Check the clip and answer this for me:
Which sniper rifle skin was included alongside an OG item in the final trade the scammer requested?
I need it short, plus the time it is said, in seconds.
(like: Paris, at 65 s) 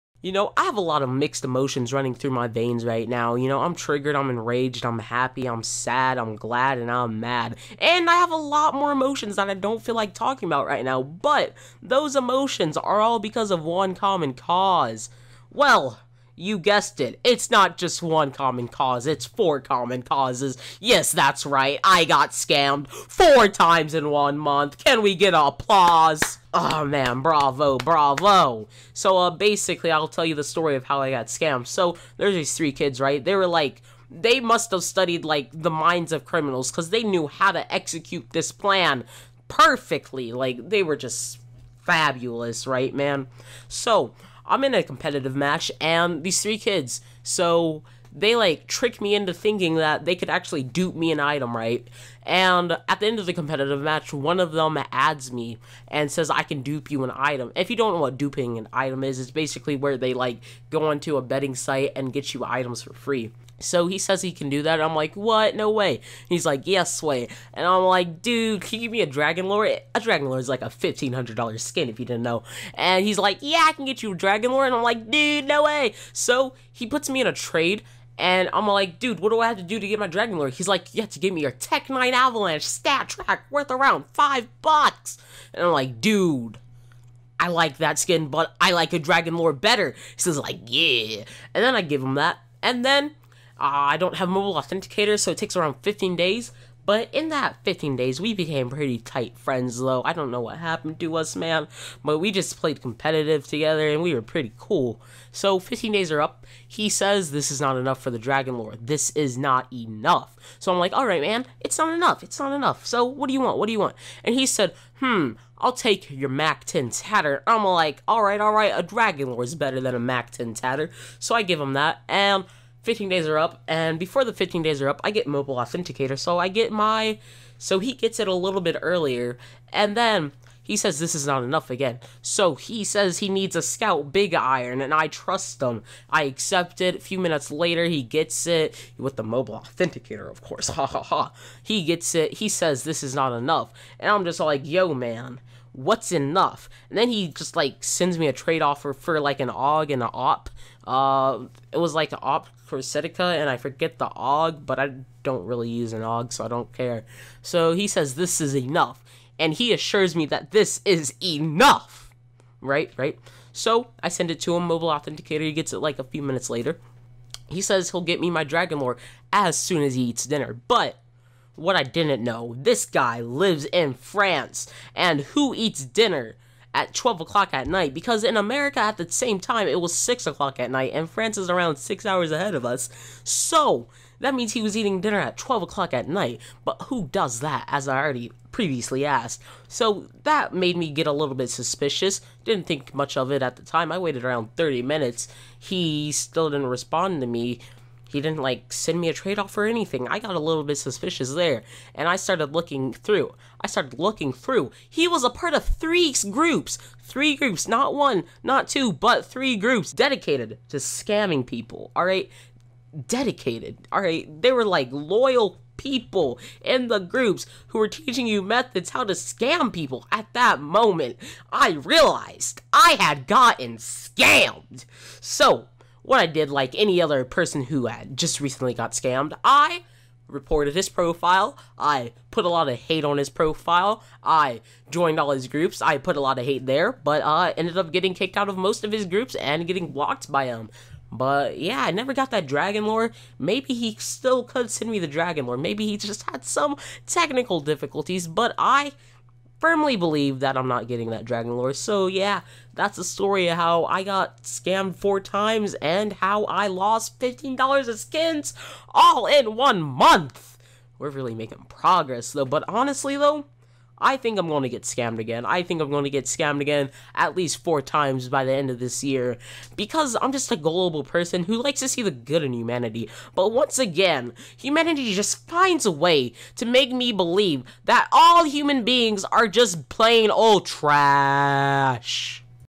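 AWP Corticera, at 152 s.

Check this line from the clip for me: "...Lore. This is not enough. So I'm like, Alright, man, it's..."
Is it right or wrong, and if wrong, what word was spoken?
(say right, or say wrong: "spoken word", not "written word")
right.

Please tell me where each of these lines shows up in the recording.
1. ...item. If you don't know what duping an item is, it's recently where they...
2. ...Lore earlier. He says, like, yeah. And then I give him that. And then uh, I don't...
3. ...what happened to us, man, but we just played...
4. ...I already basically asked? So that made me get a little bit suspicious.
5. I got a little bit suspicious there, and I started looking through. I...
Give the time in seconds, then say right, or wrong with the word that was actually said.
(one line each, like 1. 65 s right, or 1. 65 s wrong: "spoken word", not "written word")
1. 57 s wrong: "basically", not "recently"
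2. 89 s wrong: "better", not "earlier"
3. 100 s right
4. 187 s wrong: "previously", not "basically"
5. 200 s right.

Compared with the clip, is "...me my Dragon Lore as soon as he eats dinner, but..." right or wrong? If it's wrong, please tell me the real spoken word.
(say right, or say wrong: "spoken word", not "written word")
right.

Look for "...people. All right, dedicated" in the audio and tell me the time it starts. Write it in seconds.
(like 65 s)
211 s.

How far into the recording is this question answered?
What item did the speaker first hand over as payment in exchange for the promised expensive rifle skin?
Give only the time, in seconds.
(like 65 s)
81 s.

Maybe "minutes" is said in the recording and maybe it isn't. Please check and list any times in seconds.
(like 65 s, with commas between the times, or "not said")
137 s, 166 s, 194 s.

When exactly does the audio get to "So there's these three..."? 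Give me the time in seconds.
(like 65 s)
31 s.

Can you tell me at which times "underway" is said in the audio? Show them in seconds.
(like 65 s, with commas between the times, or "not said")
not said.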